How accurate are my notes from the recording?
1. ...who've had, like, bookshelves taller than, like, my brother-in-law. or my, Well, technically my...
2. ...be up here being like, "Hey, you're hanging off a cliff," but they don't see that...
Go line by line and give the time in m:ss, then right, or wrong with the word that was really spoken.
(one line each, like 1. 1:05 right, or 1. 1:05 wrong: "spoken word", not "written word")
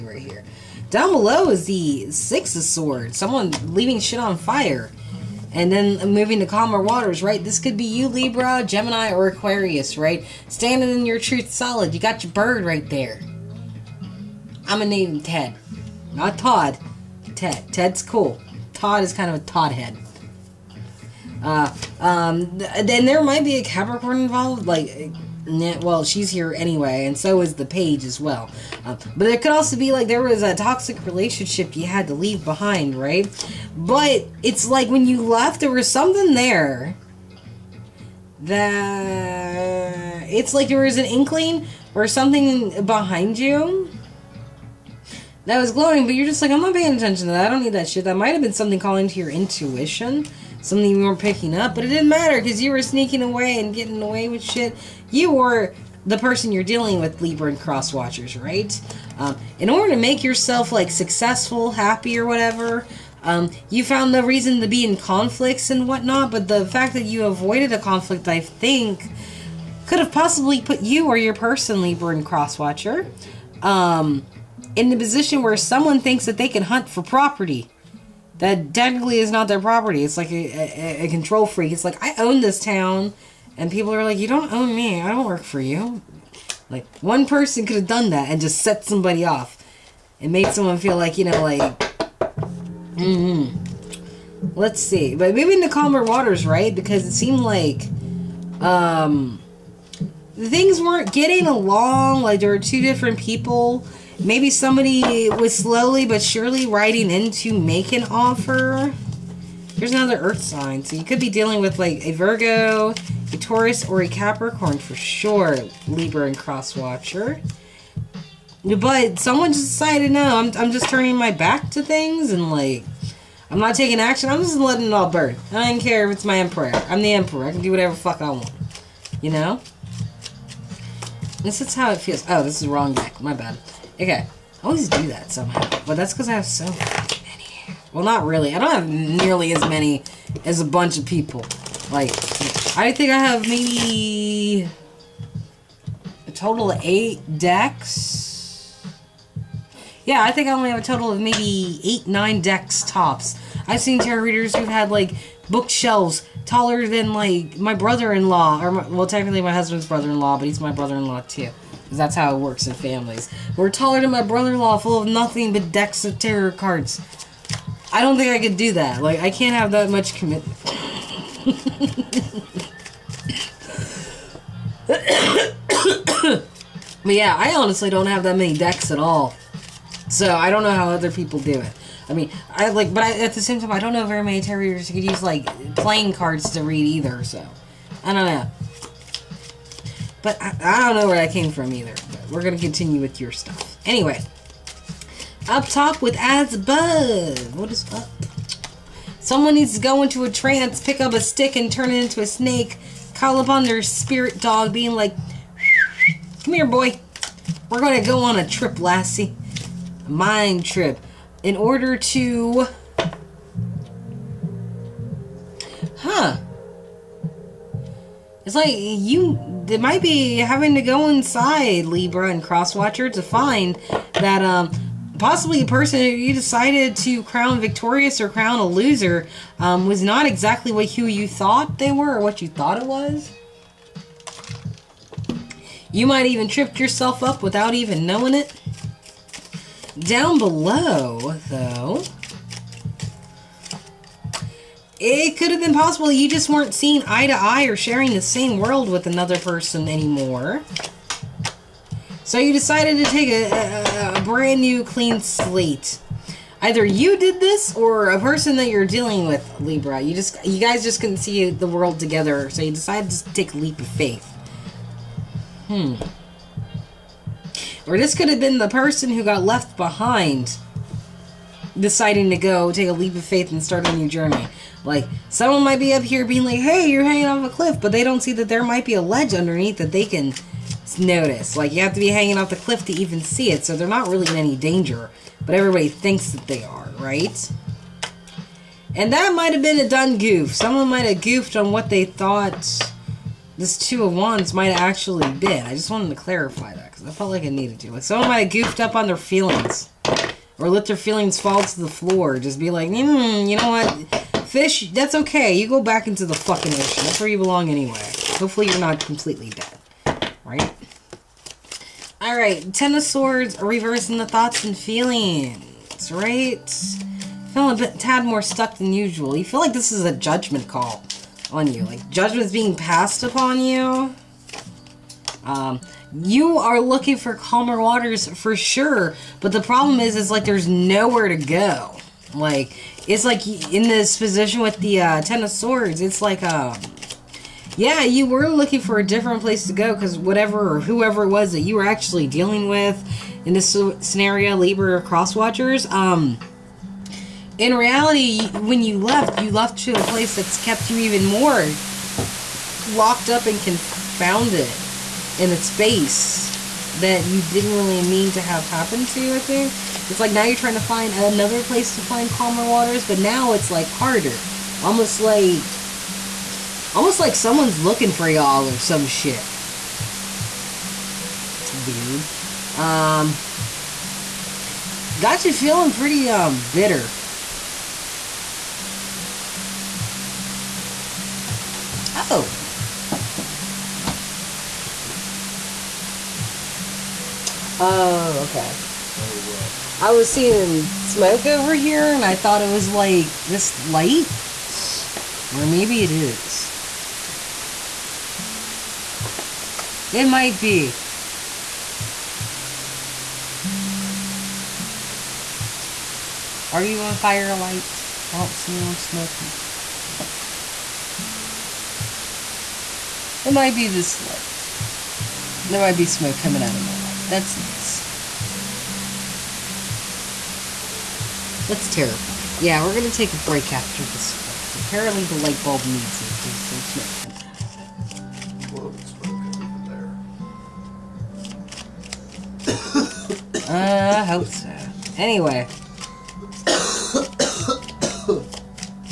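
1. 2:34 right
2. 4:35 right.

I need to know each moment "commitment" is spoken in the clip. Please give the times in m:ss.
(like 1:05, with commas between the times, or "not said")
2:50.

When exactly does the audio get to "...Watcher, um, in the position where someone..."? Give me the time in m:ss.
1:12.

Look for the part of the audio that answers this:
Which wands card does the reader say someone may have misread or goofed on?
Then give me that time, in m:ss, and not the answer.
4:53.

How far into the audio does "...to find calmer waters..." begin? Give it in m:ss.
6:01.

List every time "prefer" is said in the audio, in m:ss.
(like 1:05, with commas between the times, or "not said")
not said.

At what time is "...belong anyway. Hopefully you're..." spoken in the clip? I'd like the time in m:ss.
5:07.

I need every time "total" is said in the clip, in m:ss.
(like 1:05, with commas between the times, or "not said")
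2:26, 2:30.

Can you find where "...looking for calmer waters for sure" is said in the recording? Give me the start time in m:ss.
5:26.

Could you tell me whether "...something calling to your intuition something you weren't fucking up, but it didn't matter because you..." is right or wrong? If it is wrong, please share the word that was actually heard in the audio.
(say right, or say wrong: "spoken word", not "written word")
wrong: "picking", not "fucking".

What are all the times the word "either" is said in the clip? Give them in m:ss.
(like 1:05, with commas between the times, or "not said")
3:06, 3:11, 4:16.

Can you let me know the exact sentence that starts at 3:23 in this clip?
Call upon their spirit dog, being like, Come here, boy.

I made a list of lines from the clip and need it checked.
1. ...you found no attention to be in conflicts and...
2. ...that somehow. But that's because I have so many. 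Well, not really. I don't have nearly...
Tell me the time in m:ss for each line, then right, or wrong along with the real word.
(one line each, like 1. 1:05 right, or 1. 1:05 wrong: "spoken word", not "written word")
1. 1:03 wrong: "reason", not "attention"
2. 2:15 right.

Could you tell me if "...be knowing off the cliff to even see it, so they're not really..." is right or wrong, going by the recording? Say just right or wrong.
wrong.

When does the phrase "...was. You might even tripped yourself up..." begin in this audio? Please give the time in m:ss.
3:52.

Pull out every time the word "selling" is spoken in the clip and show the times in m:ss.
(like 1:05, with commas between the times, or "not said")
not said.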